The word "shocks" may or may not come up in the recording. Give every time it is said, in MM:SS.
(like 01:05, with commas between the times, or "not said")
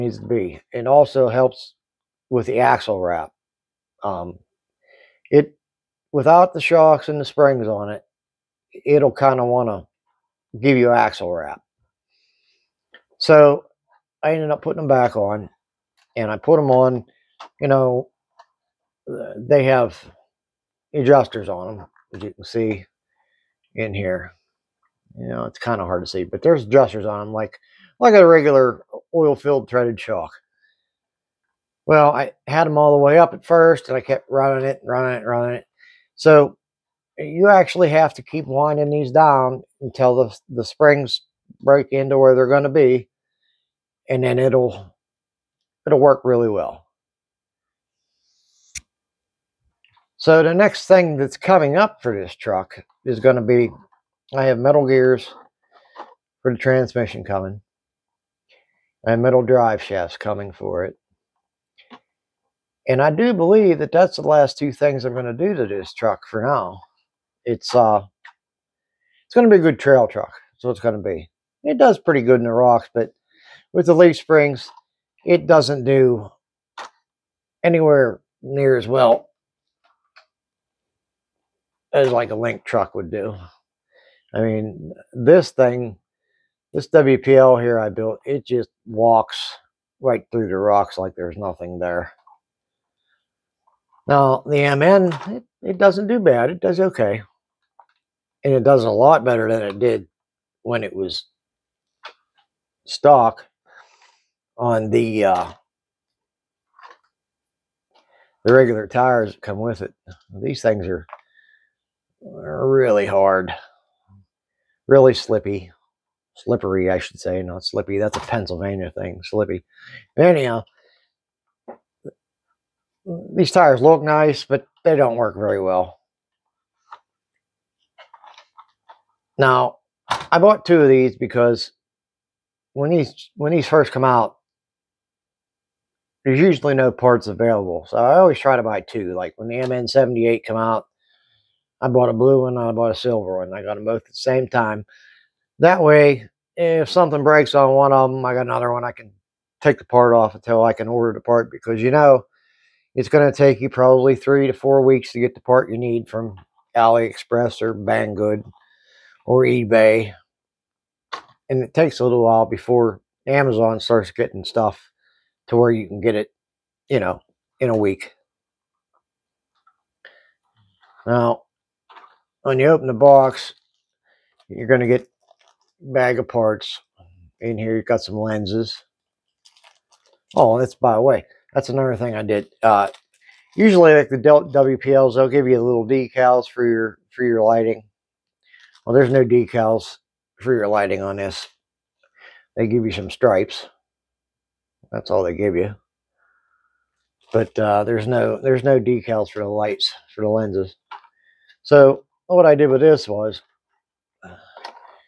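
00:06, 00:29.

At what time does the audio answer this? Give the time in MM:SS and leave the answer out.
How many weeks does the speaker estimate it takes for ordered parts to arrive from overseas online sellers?
02:34.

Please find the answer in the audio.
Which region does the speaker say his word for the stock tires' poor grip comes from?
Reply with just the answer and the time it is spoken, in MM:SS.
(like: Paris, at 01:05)
Pennsylvania, at 01:58.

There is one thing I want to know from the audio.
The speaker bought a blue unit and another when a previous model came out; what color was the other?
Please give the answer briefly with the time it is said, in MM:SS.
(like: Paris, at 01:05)
Silver, at 02:22.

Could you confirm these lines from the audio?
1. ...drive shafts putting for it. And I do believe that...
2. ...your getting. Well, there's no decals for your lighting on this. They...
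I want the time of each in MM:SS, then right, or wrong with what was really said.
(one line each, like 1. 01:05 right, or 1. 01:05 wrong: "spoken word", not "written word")
1. 00:59 wrong: "coming", not "putting"
2. 03:07 wrong: "lighting", not "getting".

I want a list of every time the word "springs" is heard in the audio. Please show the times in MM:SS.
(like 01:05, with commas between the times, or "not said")
00:07, 00:40, 01:14.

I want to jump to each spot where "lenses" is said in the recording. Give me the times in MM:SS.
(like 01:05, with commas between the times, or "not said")
02:58, 03:20.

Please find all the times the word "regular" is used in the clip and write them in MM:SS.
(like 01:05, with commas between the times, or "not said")
00:28, 01:48.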